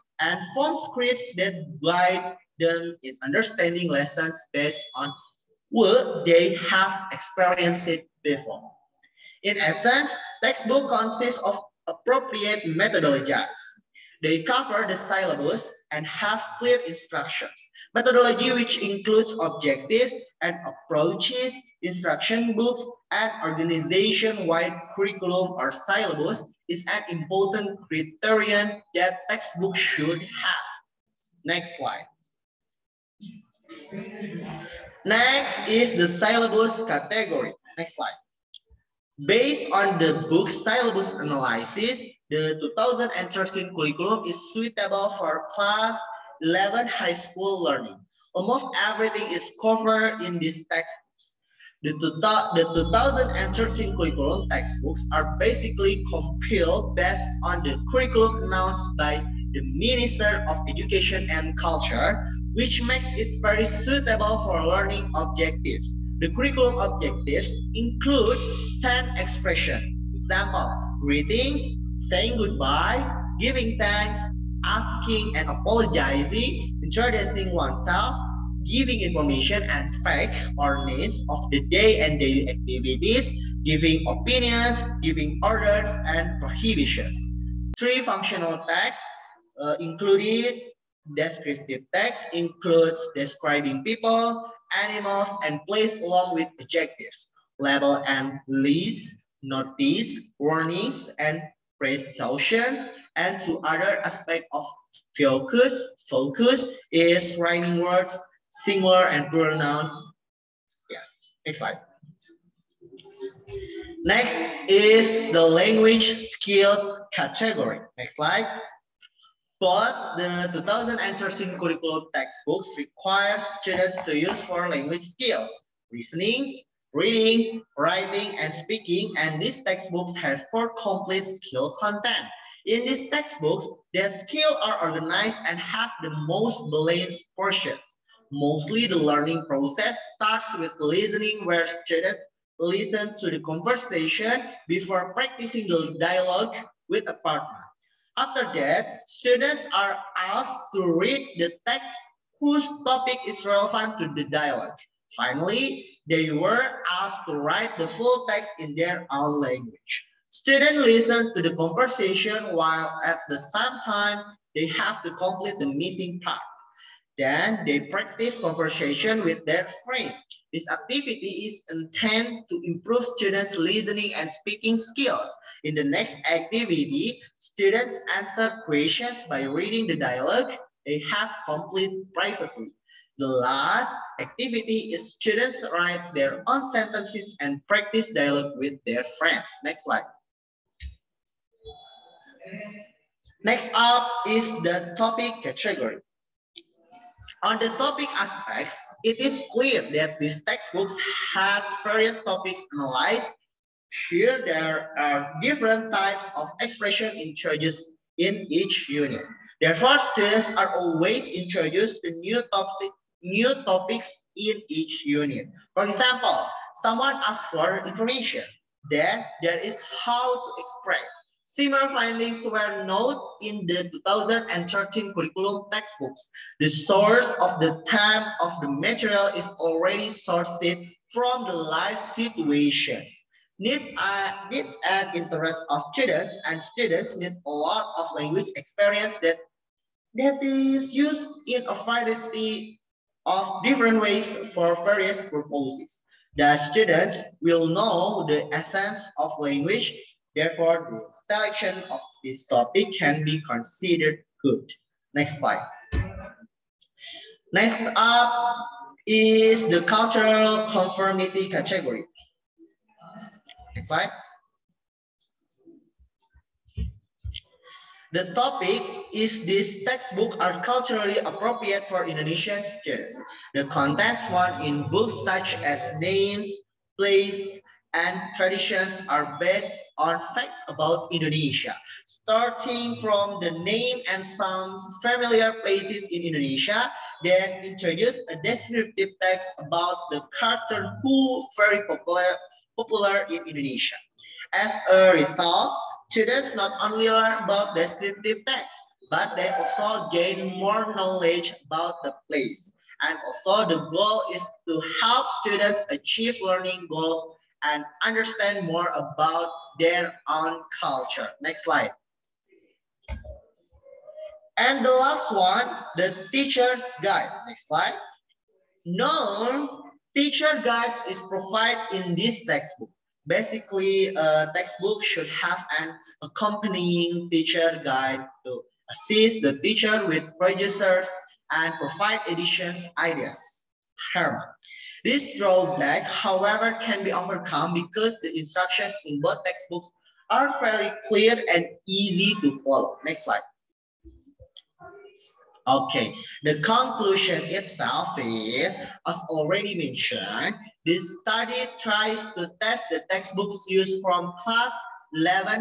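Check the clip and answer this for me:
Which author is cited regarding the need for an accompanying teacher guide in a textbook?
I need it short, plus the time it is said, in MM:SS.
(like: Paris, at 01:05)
Harmer, at 05:34.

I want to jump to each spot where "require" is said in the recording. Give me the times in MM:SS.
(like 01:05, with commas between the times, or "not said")
02:02.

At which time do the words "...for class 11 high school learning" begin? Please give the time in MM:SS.
00:45.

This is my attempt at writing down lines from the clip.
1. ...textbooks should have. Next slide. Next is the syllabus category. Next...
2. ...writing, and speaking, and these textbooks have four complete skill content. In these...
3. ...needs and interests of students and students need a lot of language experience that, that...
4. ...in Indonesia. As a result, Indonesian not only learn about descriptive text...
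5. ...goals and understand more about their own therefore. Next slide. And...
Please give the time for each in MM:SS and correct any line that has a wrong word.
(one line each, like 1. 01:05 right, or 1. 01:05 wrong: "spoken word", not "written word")
1. 00:29 right
2. 02:07 right
3. 03:54 right
4. 04:53 wrong: "Students", not "Indonesian"
5. 05:06 wrong: "culture", not "therefore".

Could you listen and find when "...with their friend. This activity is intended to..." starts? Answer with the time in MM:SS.
02:49.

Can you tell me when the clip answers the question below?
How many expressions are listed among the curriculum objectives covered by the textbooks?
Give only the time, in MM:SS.
01:08.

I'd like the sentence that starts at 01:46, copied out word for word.
Focus is writing words, singular and plural nouns.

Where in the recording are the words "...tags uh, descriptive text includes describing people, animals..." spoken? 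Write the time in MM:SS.
01:28.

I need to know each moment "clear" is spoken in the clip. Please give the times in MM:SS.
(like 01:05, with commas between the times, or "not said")
00:16, 03:19, 05:41.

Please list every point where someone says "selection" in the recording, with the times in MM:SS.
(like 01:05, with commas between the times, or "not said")
04:11.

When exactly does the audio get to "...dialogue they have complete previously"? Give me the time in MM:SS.
02:59.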